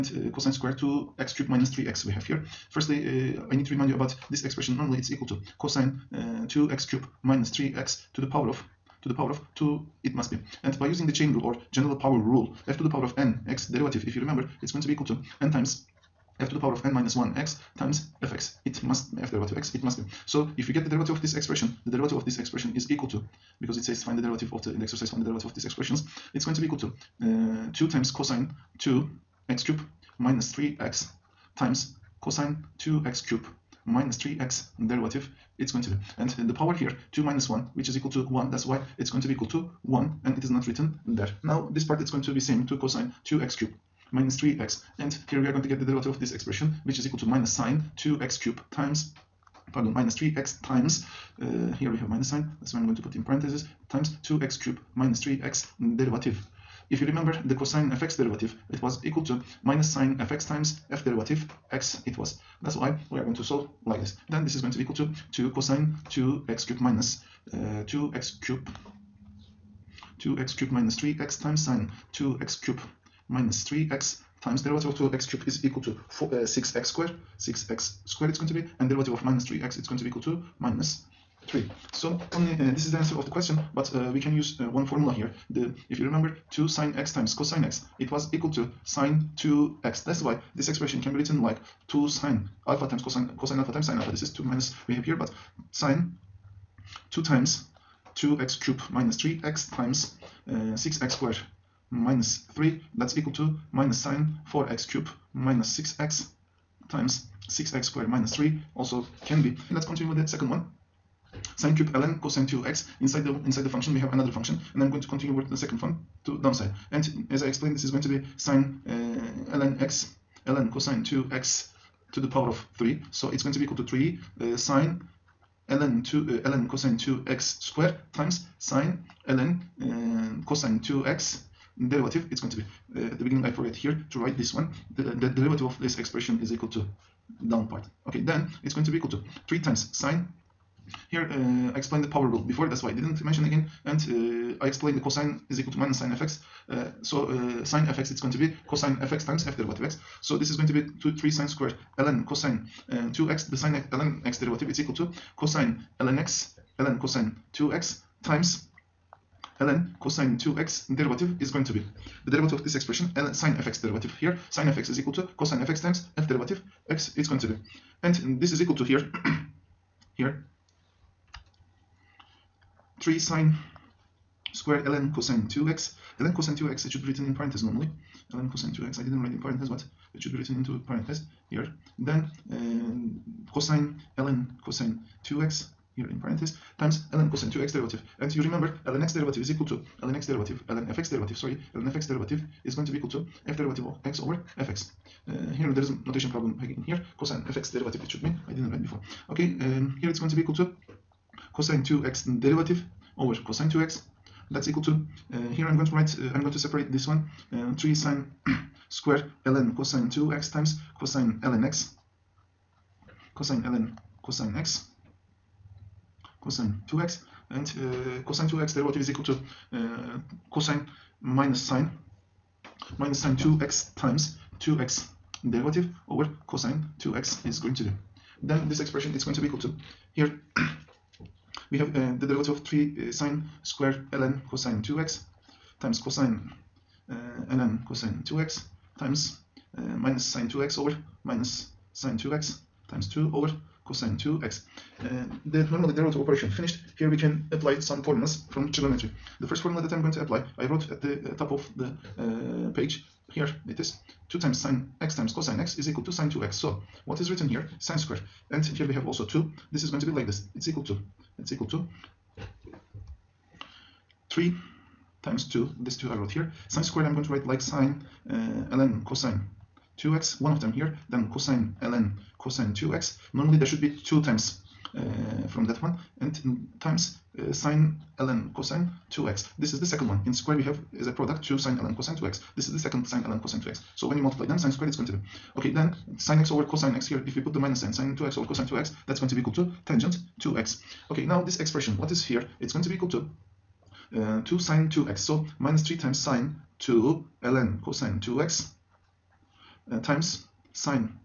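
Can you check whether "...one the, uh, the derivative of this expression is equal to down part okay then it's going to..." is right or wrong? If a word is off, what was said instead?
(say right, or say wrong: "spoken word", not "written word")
right.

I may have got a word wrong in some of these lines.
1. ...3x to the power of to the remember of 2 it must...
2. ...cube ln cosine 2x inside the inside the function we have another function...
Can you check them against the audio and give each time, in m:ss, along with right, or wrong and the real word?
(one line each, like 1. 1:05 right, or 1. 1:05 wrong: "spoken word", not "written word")
1. 0:07 wrong: "power", not "remember"
2. 1:51 right.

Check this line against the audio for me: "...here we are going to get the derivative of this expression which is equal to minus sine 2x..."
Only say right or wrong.
right.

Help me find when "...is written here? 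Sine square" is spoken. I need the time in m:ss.
4:17.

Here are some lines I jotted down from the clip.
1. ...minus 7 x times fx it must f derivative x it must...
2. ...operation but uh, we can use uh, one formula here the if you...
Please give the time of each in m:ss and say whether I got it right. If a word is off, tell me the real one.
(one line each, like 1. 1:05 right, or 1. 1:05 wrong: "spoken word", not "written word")
1. 0:16 wrong: "1", not "7"
2. 1:23 wrong: "question", not "operation".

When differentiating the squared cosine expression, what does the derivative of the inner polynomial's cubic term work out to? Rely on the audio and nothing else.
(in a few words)
6x squared.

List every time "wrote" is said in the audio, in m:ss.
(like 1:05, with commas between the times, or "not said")
4:10, 4:26.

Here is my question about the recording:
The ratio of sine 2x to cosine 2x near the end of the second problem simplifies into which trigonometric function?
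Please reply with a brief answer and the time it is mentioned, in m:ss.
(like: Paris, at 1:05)
Tangent 2x, at 4:49.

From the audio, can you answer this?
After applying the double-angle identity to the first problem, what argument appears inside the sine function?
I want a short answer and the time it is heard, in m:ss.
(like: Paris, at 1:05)
4x cubed minus 6x, at 1:44.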